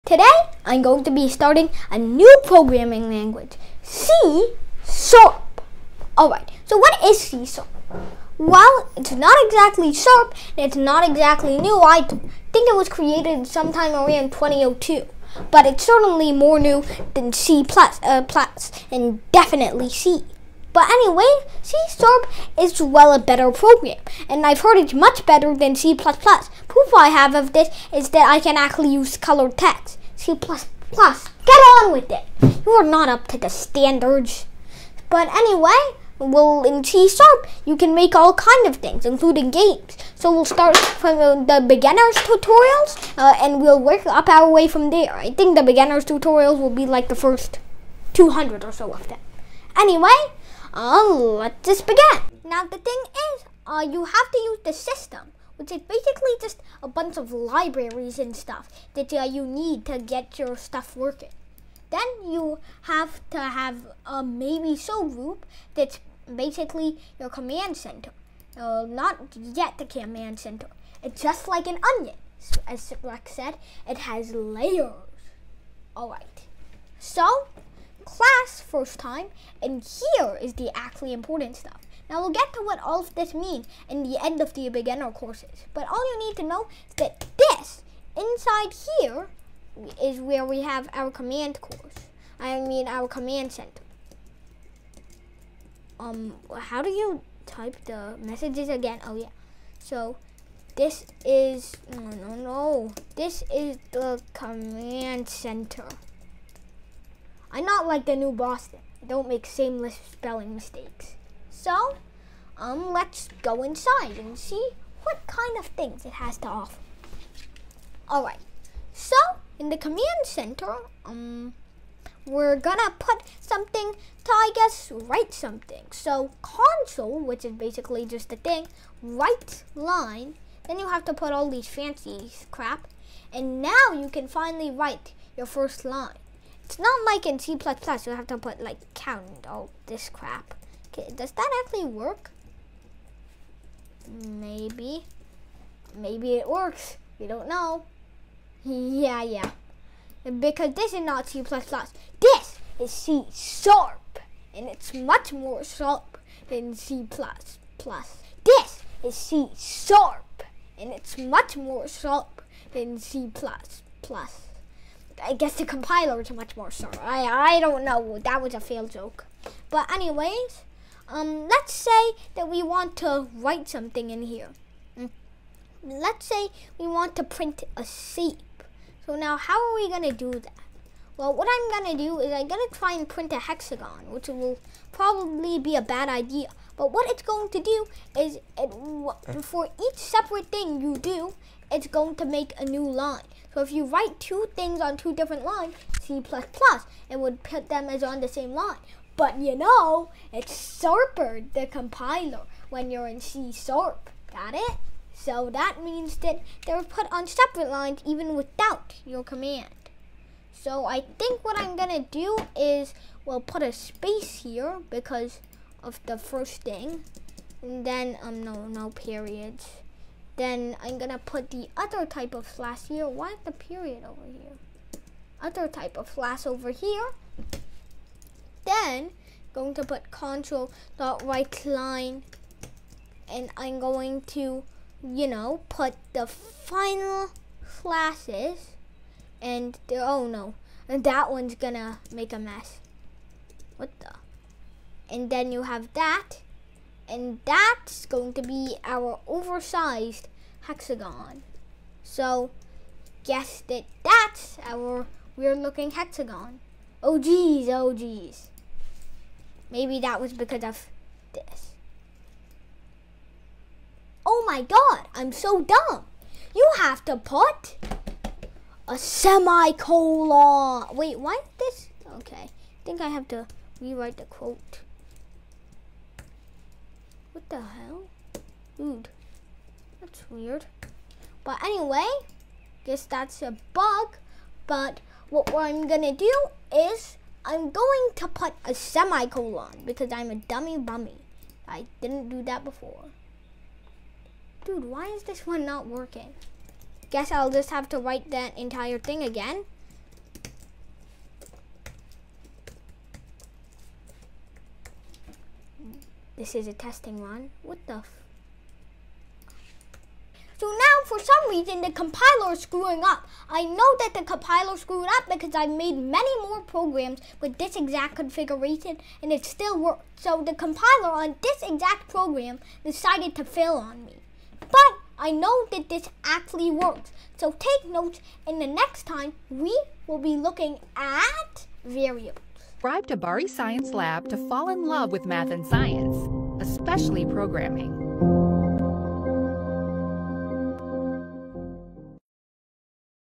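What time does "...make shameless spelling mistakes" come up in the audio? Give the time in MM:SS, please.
01:49.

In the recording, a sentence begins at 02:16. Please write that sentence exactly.
It's not like in C++, you have to put like count all this crap.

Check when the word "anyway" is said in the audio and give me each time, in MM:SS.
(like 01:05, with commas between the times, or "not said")
00:20, 00:35, 00:49, 02:49, 04:41.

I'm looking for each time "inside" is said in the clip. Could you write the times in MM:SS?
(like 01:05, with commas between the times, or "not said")
01:28, 01:53.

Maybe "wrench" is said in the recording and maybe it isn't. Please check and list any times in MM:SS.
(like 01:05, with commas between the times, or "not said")
not said.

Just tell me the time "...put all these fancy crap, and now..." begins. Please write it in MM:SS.
02:11.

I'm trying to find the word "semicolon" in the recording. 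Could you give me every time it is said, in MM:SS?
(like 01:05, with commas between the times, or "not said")
04:28, 04:48.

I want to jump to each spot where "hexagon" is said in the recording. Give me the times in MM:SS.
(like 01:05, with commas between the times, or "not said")
03:03, 04:10, 04:15.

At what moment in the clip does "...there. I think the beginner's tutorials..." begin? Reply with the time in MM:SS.
00:44.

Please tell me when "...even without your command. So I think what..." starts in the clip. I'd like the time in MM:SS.
03:28.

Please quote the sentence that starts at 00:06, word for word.
Alright, so what is C Sharp?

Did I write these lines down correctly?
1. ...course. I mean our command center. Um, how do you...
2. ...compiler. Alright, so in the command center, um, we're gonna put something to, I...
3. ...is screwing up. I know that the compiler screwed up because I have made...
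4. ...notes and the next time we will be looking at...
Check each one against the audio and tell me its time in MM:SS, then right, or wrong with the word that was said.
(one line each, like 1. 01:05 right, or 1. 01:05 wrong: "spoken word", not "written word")
1. 01:31 right
2. 01:56 wrong: "offer", not "compiler"
3. 05:12 right
4. 05:27 right.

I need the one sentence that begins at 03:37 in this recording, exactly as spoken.
And then, um, no, no periods.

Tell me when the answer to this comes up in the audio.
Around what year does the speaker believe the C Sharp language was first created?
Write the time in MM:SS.
00:14.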